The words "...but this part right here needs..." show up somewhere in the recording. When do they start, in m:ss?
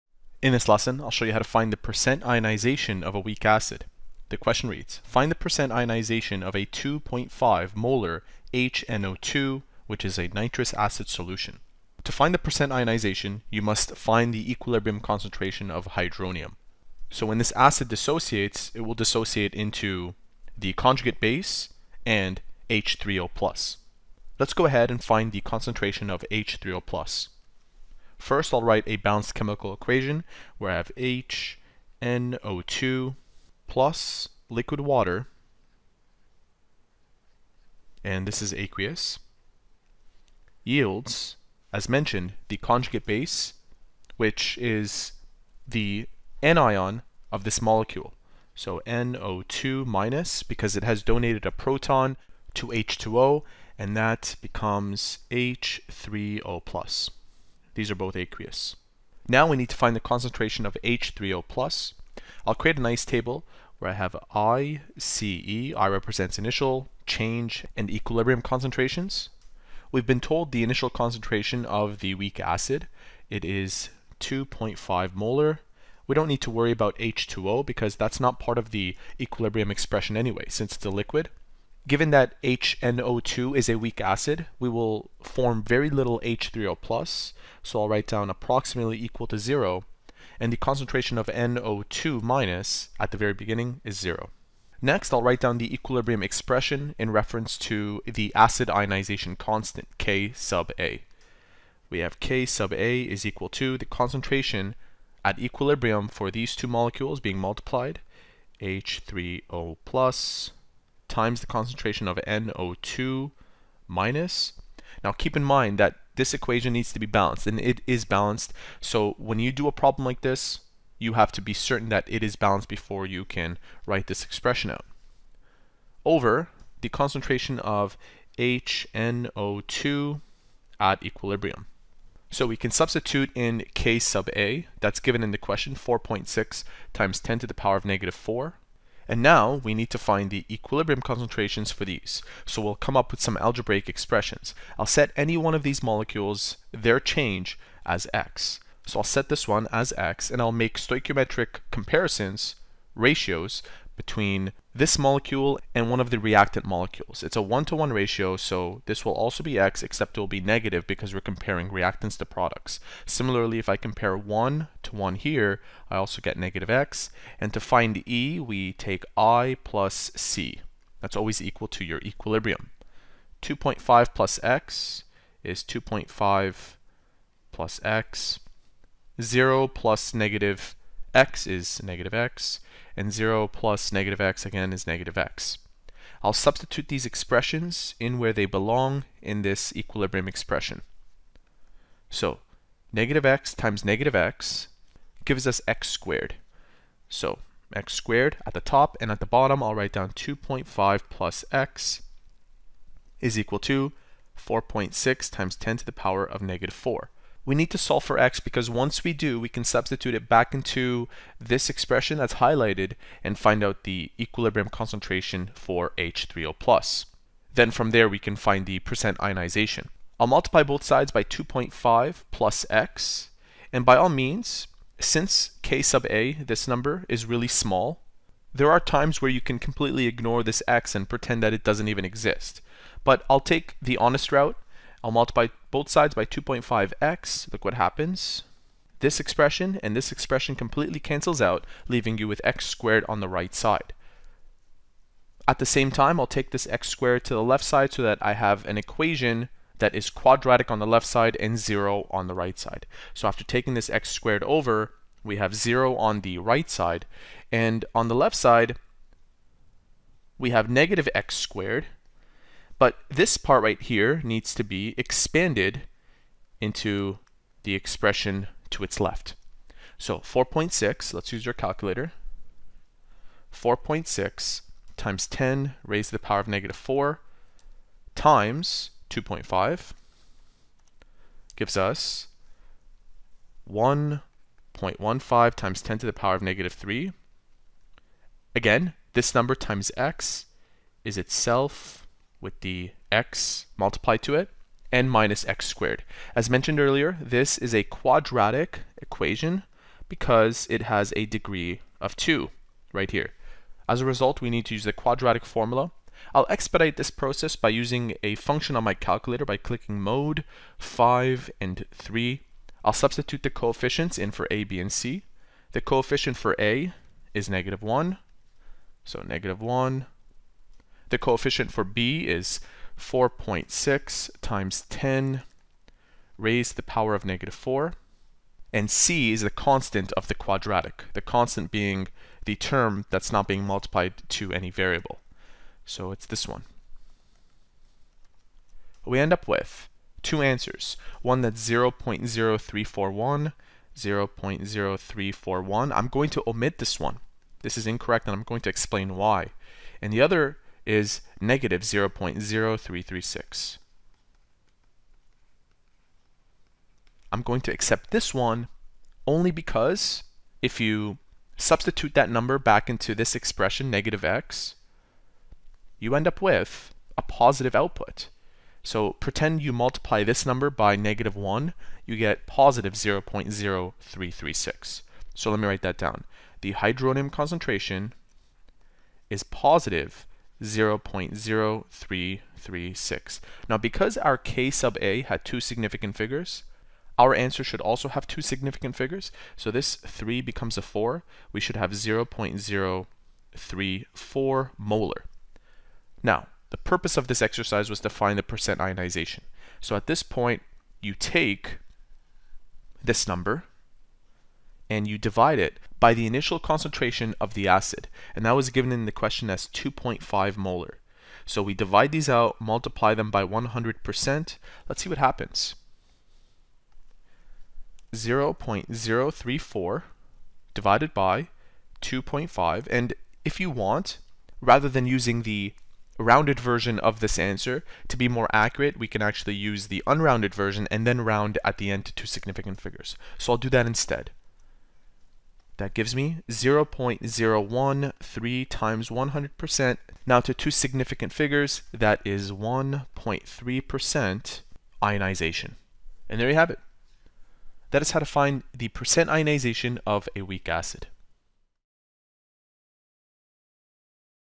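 4:22.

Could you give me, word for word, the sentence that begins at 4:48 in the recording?
Again, this number times x is itself with the x multiplied to it and minus x squared.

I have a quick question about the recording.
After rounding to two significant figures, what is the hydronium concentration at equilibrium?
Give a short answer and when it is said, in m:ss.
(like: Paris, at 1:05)
0.034 molar, at 6:31.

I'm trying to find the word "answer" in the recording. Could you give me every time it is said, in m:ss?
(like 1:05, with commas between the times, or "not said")
5:40, 6:27, 7:07.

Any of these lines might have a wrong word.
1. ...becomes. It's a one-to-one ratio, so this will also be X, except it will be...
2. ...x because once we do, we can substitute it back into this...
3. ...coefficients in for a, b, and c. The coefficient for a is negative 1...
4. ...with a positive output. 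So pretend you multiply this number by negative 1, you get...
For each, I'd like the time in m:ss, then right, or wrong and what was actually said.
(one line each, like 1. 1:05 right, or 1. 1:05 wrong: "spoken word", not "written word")
1. 2:36 wrong: "molecules", not "becomes"
2. 3:28 right
3. 5:13 right
4. 6:06 right.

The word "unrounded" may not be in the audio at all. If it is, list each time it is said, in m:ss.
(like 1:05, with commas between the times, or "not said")
7:10.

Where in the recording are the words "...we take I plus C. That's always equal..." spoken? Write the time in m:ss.
2:48.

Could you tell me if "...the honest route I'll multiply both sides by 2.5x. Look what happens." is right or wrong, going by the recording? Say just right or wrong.
right.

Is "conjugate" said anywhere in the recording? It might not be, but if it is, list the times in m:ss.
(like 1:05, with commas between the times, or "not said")
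0:20, 0:42.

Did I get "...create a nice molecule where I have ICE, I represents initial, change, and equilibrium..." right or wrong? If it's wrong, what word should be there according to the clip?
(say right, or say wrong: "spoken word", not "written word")
wrong: "table", not "molecule".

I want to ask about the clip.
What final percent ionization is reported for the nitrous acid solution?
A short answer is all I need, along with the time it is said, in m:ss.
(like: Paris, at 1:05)
1.3%, at 7:22.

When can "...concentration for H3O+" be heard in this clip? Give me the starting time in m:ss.
3:34.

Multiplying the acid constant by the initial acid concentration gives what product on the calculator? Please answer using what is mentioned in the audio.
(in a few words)
1.15 x 10^-3.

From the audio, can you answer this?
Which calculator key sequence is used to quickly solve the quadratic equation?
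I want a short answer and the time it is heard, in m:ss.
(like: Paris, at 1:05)
mode 5 and 3, at 5:10.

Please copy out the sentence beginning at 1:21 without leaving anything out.
Given that HNO2 is a weak acid, we will form very little H3O+, plus.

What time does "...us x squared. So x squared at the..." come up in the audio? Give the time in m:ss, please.
3:15.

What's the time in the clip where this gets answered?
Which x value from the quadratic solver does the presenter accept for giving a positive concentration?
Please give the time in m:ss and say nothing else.
5:51.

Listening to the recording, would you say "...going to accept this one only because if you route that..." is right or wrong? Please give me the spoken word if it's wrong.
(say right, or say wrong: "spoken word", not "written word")
wrong: "substitute", not "route".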